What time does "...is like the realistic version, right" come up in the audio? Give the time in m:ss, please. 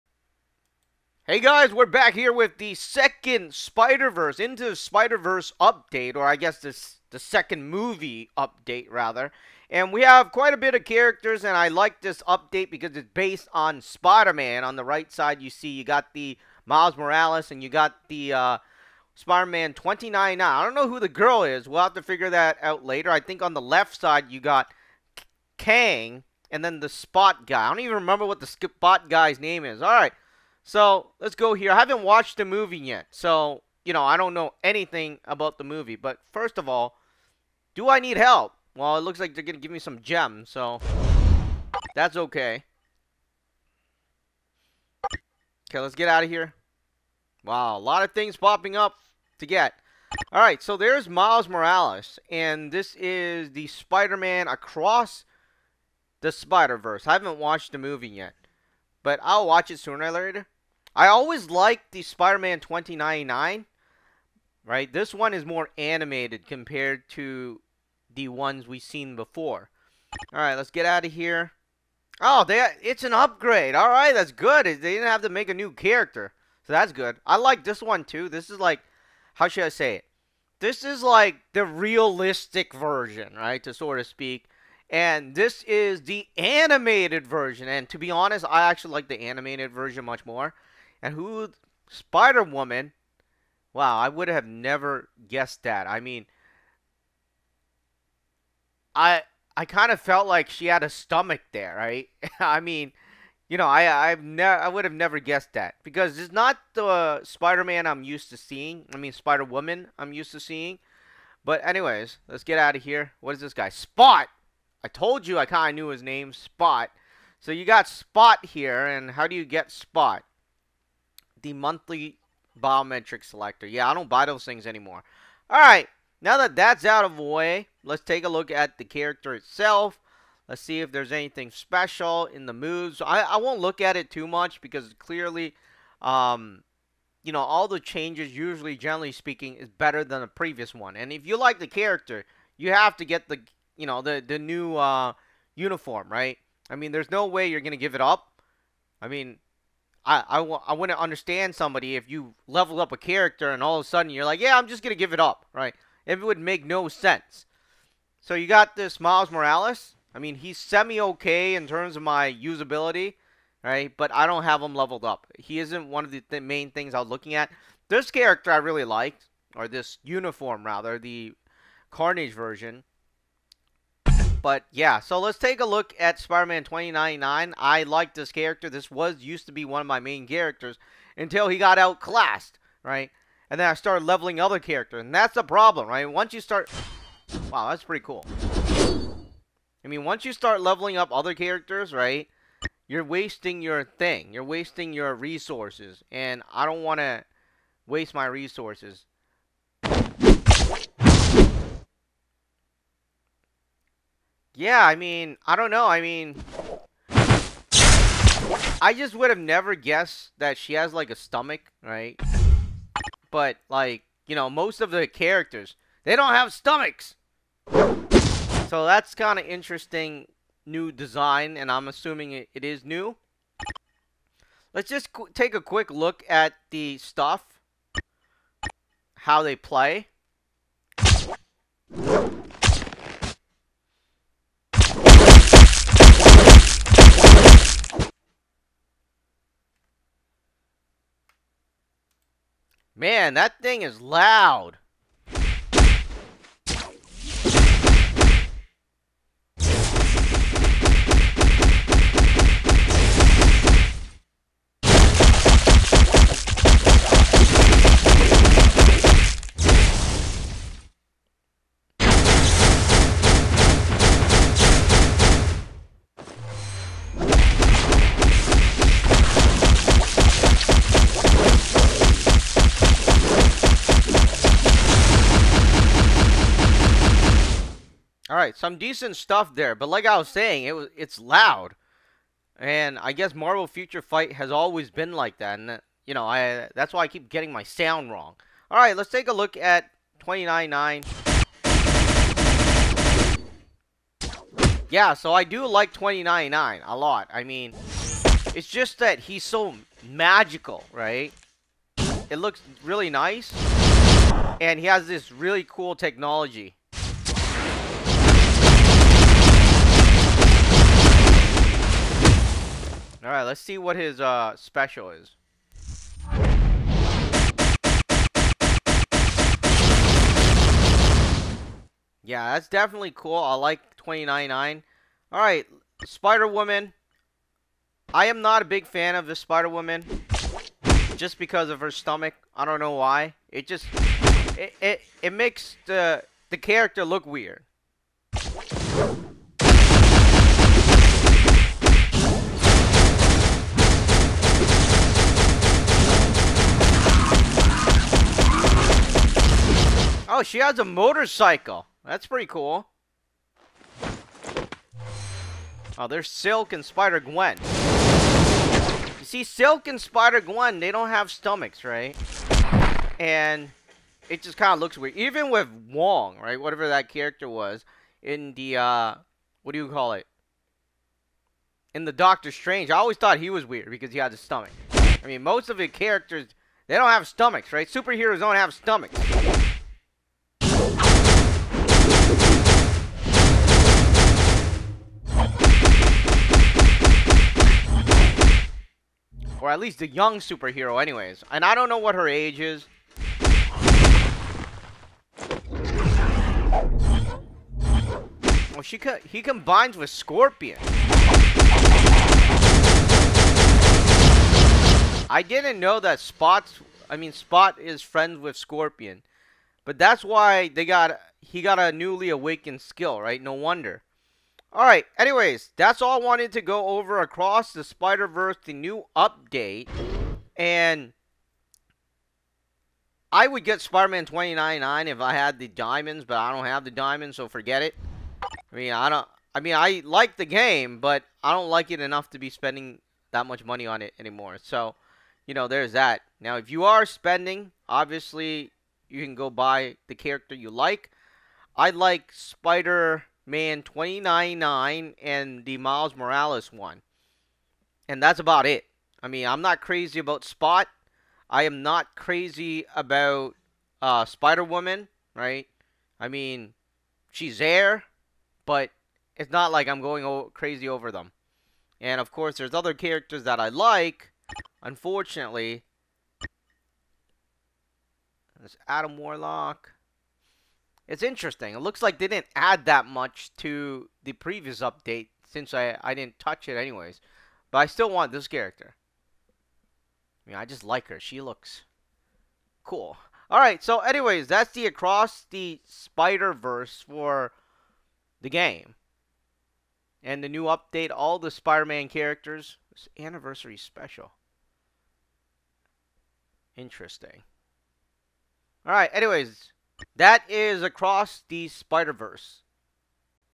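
1:20.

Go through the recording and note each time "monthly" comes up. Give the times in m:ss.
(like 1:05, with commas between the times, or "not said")
2:01.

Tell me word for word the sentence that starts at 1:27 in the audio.
And to be honest, I actually like the animated version much more.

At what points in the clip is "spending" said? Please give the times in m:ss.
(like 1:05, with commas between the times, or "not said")
7:12, 7:17.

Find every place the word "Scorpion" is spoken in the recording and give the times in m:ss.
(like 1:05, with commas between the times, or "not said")
6:40, 6:48.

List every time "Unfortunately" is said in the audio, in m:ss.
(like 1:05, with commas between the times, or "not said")
7:44.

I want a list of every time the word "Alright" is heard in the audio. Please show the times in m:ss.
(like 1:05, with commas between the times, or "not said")
6:54, 8:03, 8:18.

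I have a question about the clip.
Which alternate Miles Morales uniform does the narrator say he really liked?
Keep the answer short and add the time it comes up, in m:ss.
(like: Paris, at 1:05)
Carnage version, at 2:50.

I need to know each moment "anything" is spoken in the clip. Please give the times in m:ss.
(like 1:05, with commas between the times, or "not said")
0:34, 2:11.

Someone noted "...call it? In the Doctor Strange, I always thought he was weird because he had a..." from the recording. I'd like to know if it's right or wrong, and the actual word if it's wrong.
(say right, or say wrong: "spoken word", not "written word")
right.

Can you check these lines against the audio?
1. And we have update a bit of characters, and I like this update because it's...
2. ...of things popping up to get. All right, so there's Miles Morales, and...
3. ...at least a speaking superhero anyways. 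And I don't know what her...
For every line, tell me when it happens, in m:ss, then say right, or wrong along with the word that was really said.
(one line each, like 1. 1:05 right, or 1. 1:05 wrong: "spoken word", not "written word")
1. 0:09 wrong: "quite", not "update"
2. 0:48 right
3. 6:29 wrong: "young", not "speaking".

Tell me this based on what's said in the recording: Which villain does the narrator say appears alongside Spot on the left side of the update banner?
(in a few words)
Kang.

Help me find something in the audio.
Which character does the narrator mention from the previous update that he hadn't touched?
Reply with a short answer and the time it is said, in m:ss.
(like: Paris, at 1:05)
Adam Warlock, at 7:48.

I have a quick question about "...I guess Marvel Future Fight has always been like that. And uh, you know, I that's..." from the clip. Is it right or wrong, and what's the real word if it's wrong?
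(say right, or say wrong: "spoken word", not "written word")
right.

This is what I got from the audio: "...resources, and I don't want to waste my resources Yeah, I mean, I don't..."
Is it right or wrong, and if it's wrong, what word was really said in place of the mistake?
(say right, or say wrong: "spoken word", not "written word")
right.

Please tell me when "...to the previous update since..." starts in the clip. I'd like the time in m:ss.
7:53.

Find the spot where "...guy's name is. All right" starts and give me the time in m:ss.
0:29.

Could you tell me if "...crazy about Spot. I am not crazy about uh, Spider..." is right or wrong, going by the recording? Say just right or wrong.
right.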